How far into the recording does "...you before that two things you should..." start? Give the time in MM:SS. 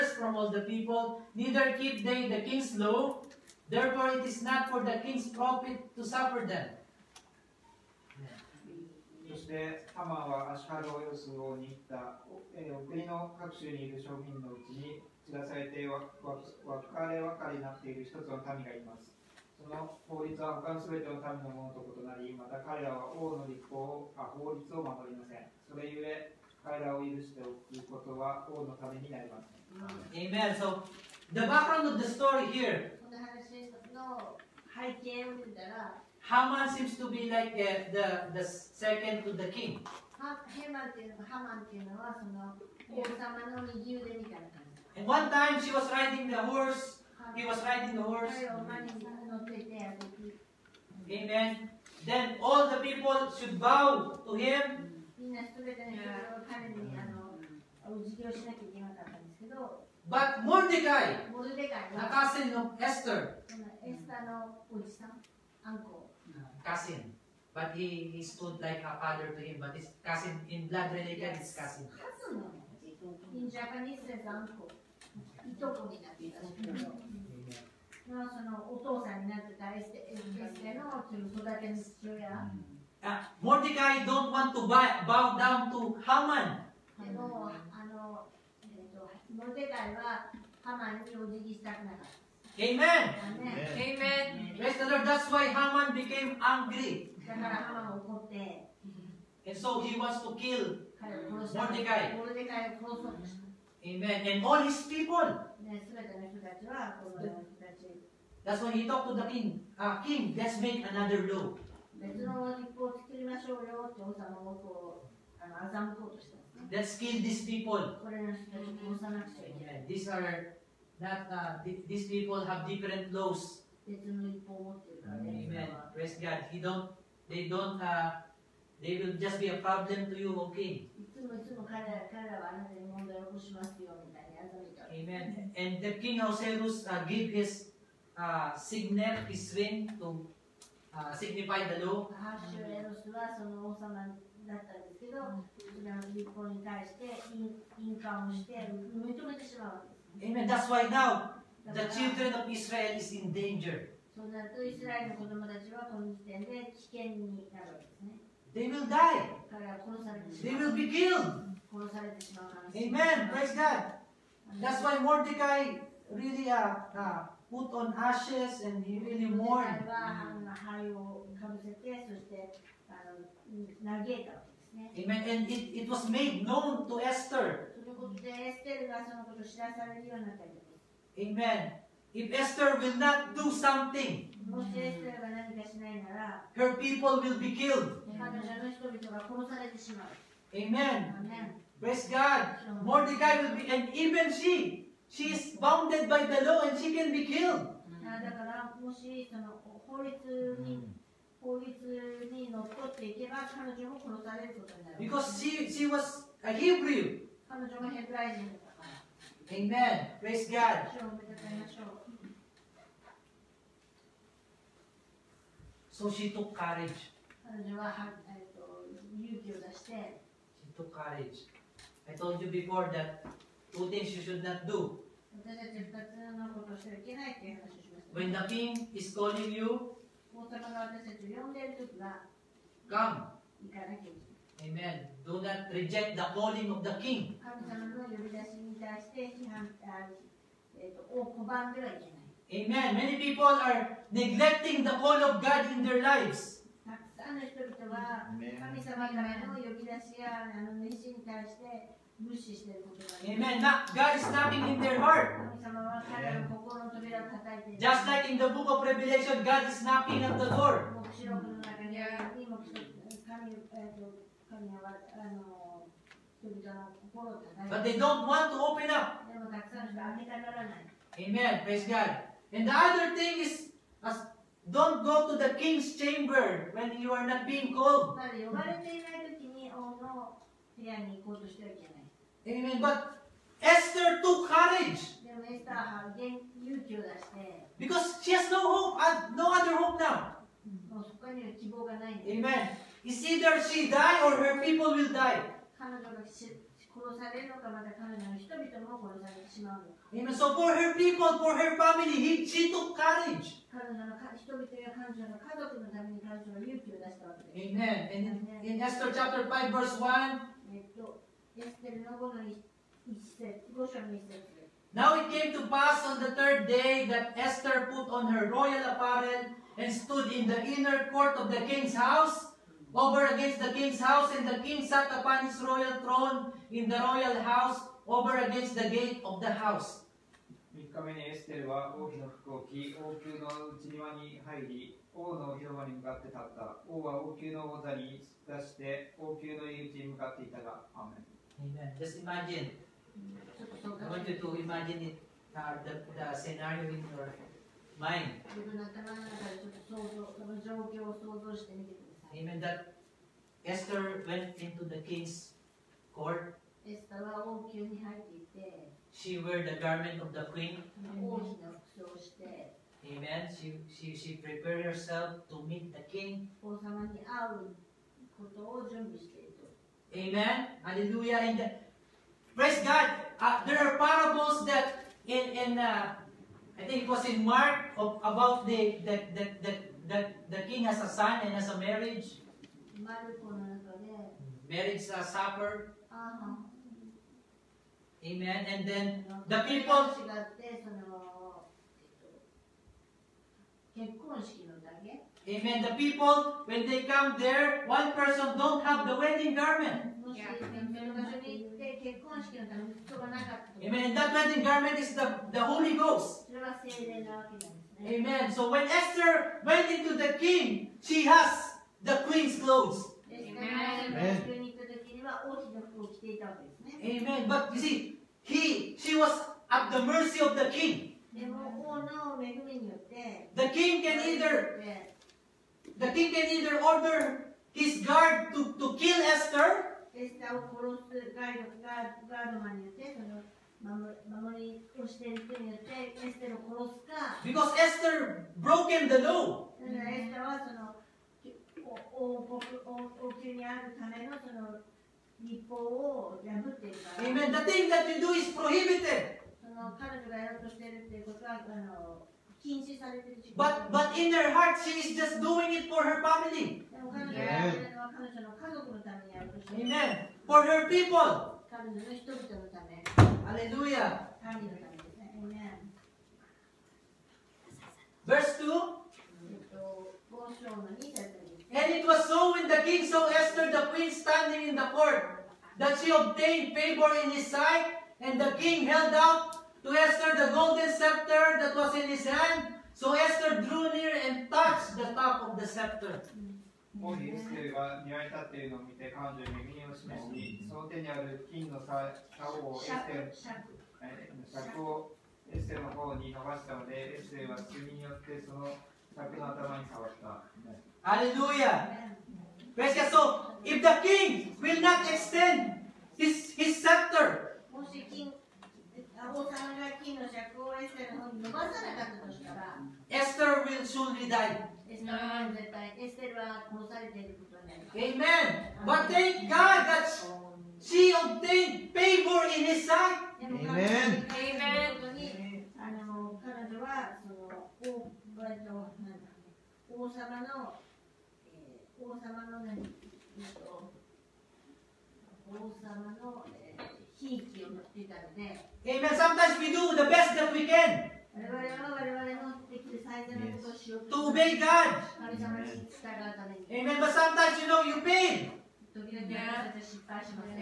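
03:42.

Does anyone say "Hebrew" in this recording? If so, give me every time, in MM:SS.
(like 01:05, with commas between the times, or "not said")
03:26.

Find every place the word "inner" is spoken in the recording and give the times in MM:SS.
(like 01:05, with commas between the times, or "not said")
05:20.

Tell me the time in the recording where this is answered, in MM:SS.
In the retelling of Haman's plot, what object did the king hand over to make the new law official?
02:19.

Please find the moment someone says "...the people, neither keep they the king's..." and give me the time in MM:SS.
00:00.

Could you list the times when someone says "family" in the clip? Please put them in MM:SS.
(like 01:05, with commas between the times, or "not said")
05:01, 07:36.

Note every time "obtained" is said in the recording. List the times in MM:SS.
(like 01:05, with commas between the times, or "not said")
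07:56, 08:41.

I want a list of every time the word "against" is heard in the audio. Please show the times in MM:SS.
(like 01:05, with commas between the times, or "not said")
05:23, 05:28.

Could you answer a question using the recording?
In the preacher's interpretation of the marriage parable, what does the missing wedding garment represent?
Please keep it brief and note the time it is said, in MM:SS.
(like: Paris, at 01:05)
the Holy Ghost, at 06:45.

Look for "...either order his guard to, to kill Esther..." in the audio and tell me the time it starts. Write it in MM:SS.
07:06.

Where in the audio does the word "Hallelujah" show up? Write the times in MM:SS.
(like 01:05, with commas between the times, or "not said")
06:10, 07:43, 08:21.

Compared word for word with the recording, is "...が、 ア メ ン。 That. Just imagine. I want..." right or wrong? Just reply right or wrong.
wrong.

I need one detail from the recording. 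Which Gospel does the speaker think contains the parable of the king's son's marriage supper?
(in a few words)
Mark.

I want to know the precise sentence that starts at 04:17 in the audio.
Just like in the book of Revelation, God is knocking at the door.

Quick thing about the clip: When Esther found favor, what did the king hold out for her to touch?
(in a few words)
the golden scepter.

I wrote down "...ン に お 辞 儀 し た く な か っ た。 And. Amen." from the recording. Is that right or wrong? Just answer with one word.
wrong.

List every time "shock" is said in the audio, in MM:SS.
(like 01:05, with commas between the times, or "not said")
not said.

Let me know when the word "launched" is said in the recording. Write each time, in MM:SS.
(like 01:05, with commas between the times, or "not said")
not said.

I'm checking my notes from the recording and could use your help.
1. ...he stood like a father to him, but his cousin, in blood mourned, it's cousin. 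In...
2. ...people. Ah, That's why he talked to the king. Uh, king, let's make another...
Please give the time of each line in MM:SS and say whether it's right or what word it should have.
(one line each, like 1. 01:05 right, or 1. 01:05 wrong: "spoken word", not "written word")
1. 01:08 wrong: "related", not "mourned"
2. 01:44 right.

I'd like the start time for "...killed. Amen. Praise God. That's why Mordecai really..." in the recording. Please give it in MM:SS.
02:40.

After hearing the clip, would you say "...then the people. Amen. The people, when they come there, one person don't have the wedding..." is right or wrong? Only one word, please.
right.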